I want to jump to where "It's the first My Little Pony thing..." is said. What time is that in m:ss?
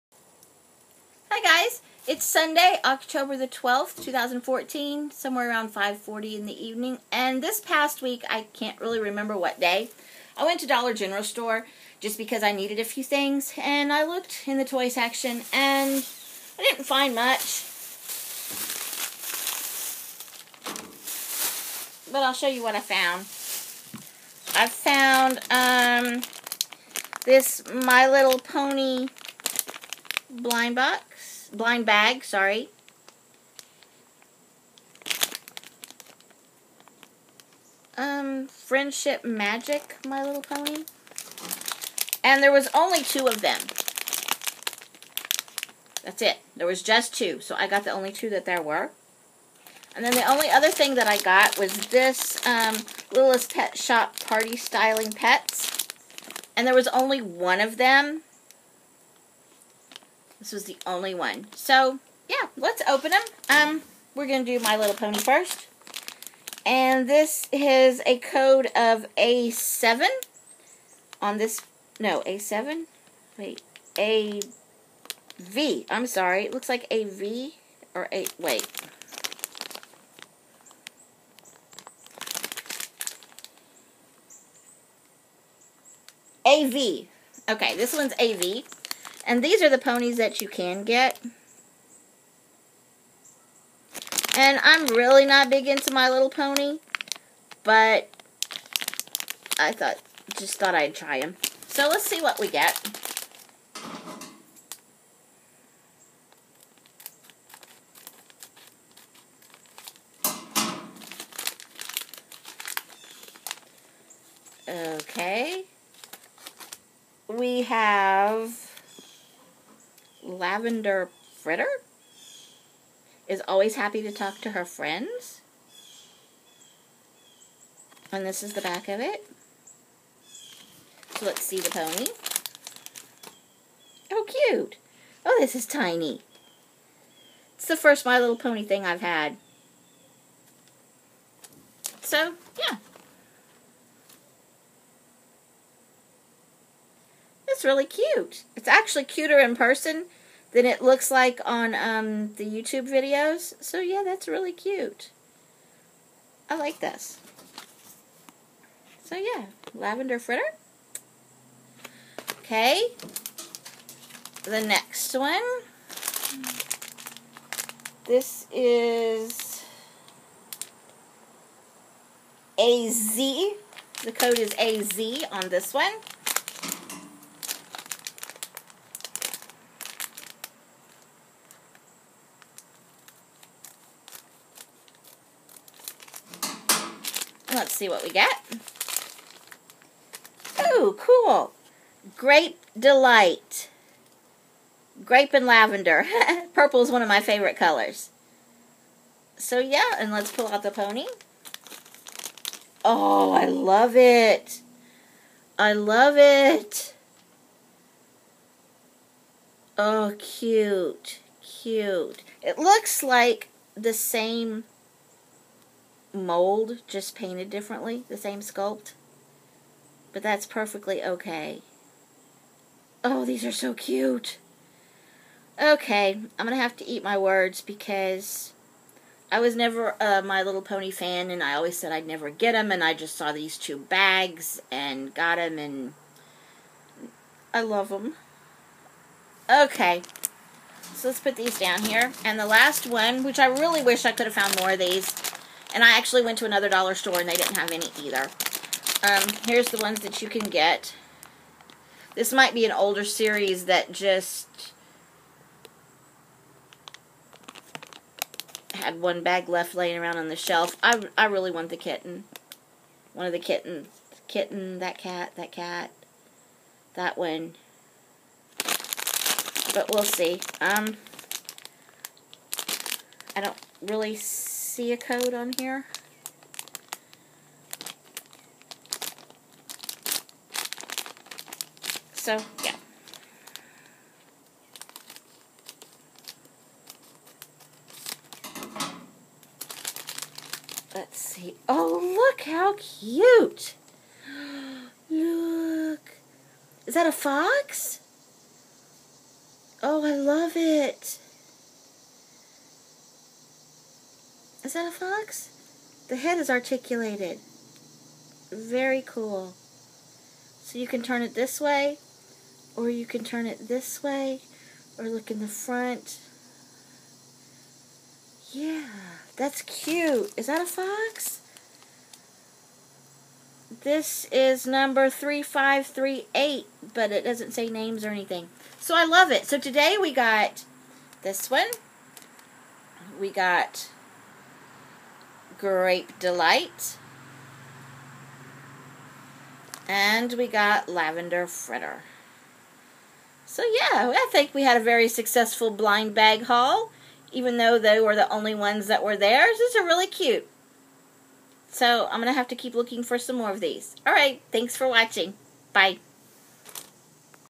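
2:17.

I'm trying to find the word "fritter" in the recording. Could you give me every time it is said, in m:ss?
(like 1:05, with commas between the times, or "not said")
2:01, 2:40, 5:41.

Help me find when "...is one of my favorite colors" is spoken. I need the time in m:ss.
3:16.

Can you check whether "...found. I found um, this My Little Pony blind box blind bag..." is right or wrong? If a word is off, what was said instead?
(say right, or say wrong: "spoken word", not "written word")
right.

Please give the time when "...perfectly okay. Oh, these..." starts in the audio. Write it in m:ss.
3:40.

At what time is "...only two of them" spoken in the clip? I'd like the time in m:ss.
0:42.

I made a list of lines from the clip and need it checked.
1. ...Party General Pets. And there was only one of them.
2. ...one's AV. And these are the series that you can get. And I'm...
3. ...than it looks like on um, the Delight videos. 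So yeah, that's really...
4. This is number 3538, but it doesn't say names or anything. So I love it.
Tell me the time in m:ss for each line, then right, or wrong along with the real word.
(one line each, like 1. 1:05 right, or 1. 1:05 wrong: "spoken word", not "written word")
1. 0:54 wrong: "Styling", not "General"
2. 1:27 wrong: "ponies", not "series"
3. 2:30 wrong: "YouTube", not "Delight"
4. 5:23 right.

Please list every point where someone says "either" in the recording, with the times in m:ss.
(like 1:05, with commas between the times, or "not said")
4:08.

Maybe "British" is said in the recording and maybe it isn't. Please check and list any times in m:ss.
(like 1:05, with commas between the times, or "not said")
not said.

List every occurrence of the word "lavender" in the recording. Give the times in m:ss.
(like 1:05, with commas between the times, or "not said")
2:00, 2:39, 3:15, 5:40.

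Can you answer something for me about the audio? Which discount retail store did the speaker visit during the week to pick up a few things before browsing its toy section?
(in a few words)
Dollar General.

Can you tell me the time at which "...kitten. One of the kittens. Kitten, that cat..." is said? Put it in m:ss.
4:21.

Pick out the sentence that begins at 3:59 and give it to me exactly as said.
Okay, so let's put these down here.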